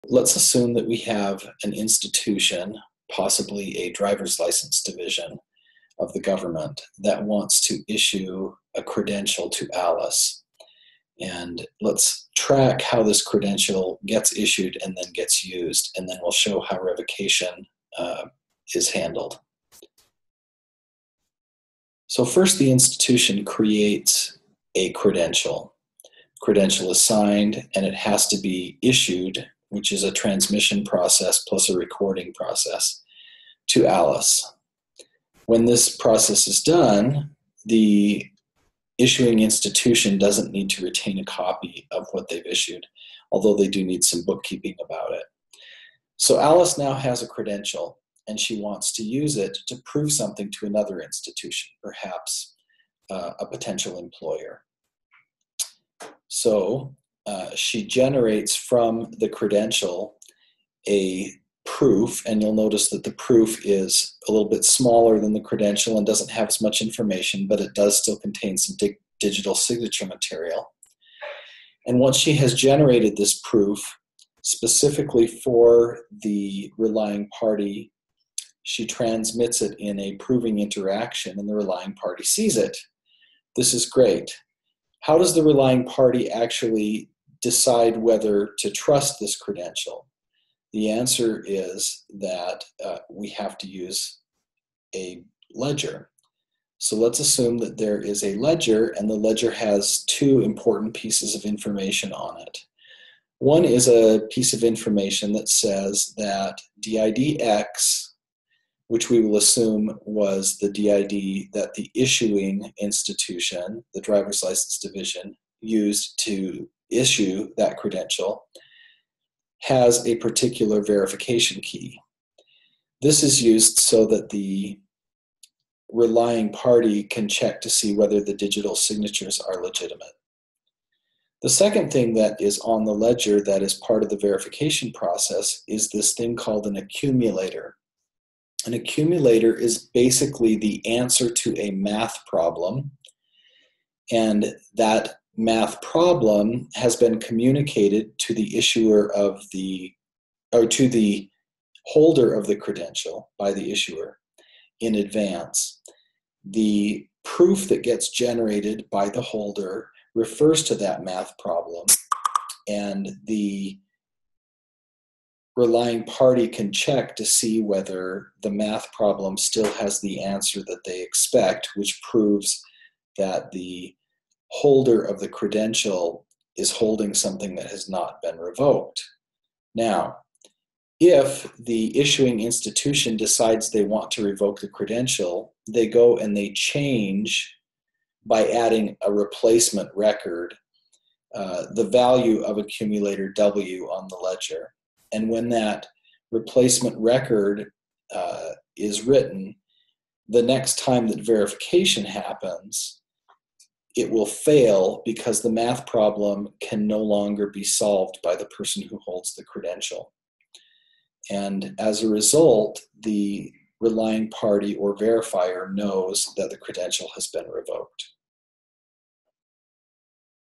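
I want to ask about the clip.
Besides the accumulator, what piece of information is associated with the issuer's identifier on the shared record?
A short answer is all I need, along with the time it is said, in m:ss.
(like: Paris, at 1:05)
verification key, at 2:00.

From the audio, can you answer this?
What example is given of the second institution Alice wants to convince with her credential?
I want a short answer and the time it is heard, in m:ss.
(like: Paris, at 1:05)
a potential employer, at 0:53.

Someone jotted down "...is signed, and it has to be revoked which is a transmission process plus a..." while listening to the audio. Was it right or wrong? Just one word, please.
wrong.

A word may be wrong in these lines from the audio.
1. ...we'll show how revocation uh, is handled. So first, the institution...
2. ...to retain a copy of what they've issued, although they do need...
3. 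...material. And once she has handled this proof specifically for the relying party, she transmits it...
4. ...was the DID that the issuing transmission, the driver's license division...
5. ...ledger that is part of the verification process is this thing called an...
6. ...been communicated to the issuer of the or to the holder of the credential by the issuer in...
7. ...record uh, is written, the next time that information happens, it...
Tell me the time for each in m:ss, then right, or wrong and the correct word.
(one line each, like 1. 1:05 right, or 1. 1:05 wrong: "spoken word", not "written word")
1. 0:16 right
2. 0:40 right
3. 1:10 wrong: "generated", not "handled"
4. 1:50 wrong: "institution", not "transmission"
5. 2:12 right
6. 2:26 right
7. 3:16 wrong: "verification", not "information".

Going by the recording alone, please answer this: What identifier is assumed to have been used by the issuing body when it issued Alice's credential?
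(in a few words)
DIDX.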